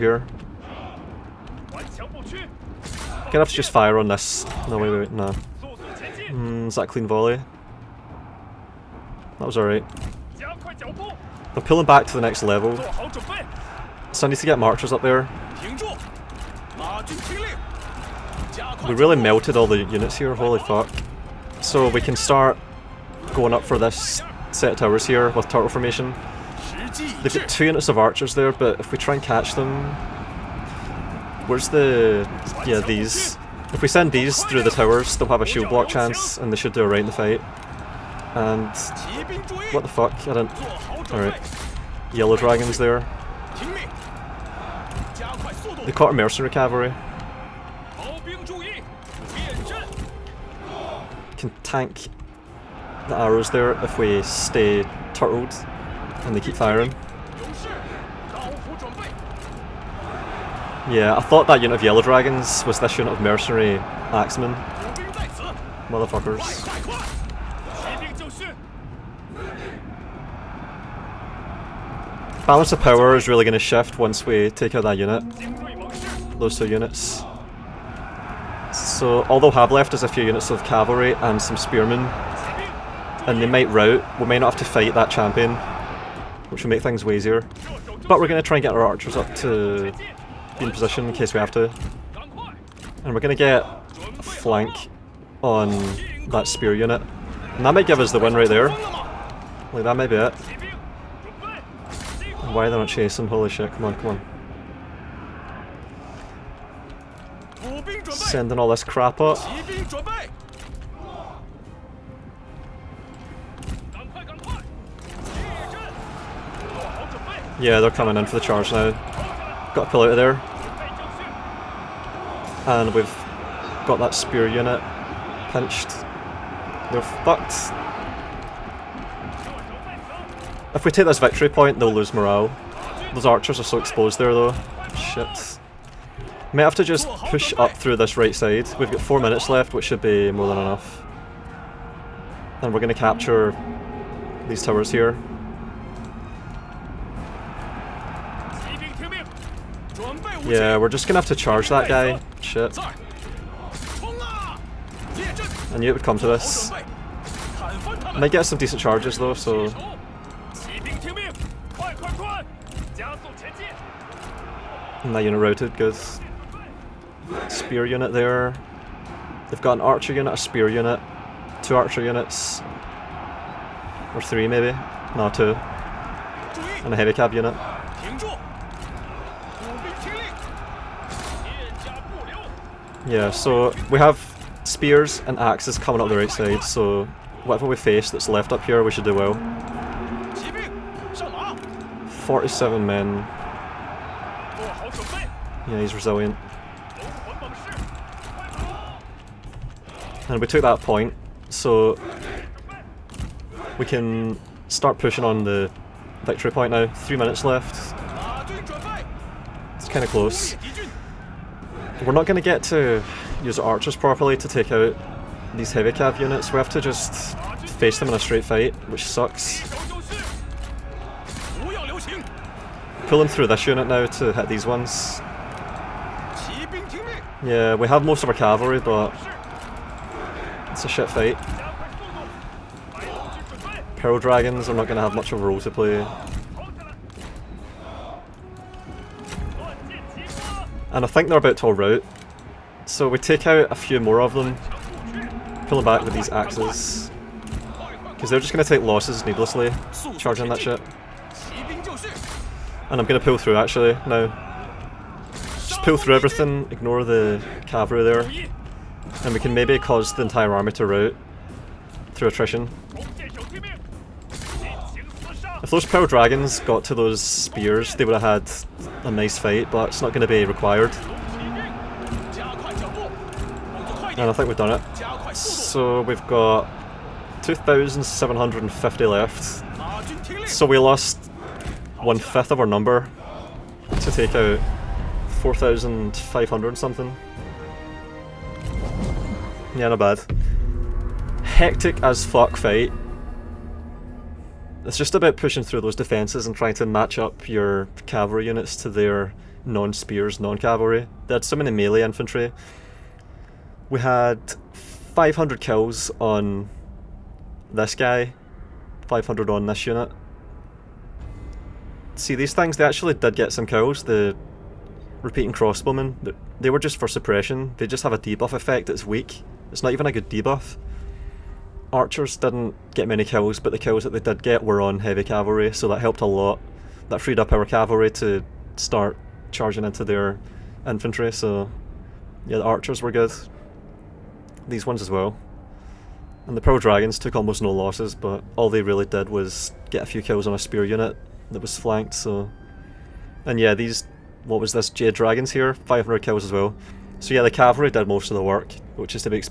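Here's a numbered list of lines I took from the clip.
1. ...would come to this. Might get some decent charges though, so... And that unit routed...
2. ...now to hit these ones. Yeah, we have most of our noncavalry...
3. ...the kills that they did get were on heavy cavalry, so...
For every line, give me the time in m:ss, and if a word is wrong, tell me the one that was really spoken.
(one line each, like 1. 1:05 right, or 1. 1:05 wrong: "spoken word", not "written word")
1. 2:35 right
2. 3:43 wrong: "cavalry", not "noncavalry"
3. 5:23 right.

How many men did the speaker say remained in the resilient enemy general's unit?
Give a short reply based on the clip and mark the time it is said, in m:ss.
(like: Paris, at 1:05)
47, at 3:12.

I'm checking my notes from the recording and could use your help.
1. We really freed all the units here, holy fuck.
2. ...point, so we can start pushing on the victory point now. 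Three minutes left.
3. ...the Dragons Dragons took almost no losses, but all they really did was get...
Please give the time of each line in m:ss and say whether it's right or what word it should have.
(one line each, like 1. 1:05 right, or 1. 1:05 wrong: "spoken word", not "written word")
1. 0:18 wrong: "melted", not "freed"
2. 3:20 right
3. 5:36 wrong: "Pearl", not "Dragons".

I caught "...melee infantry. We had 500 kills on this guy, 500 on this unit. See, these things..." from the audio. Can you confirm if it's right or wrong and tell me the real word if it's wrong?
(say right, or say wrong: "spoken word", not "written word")
right.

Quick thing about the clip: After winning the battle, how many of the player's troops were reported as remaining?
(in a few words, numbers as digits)
2,750.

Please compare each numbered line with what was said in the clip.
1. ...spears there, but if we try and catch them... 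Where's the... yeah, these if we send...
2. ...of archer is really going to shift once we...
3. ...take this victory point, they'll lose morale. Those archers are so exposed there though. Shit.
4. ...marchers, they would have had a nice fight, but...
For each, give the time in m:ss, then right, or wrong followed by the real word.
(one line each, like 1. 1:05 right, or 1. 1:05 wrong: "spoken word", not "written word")
1. 0:27 wrong: "archers", not "spears"
2. 1:12 wrong: "power", not "archer"
3. 2:10 right
4. 4:27 wrong: "spears", not "marchers".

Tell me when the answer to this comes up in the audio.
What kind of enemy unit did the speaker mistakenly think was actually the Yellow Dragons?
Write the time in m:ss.
1:03.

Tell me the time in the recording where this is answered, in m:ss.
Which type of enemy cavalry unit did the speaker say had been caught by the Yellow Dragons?
0:46.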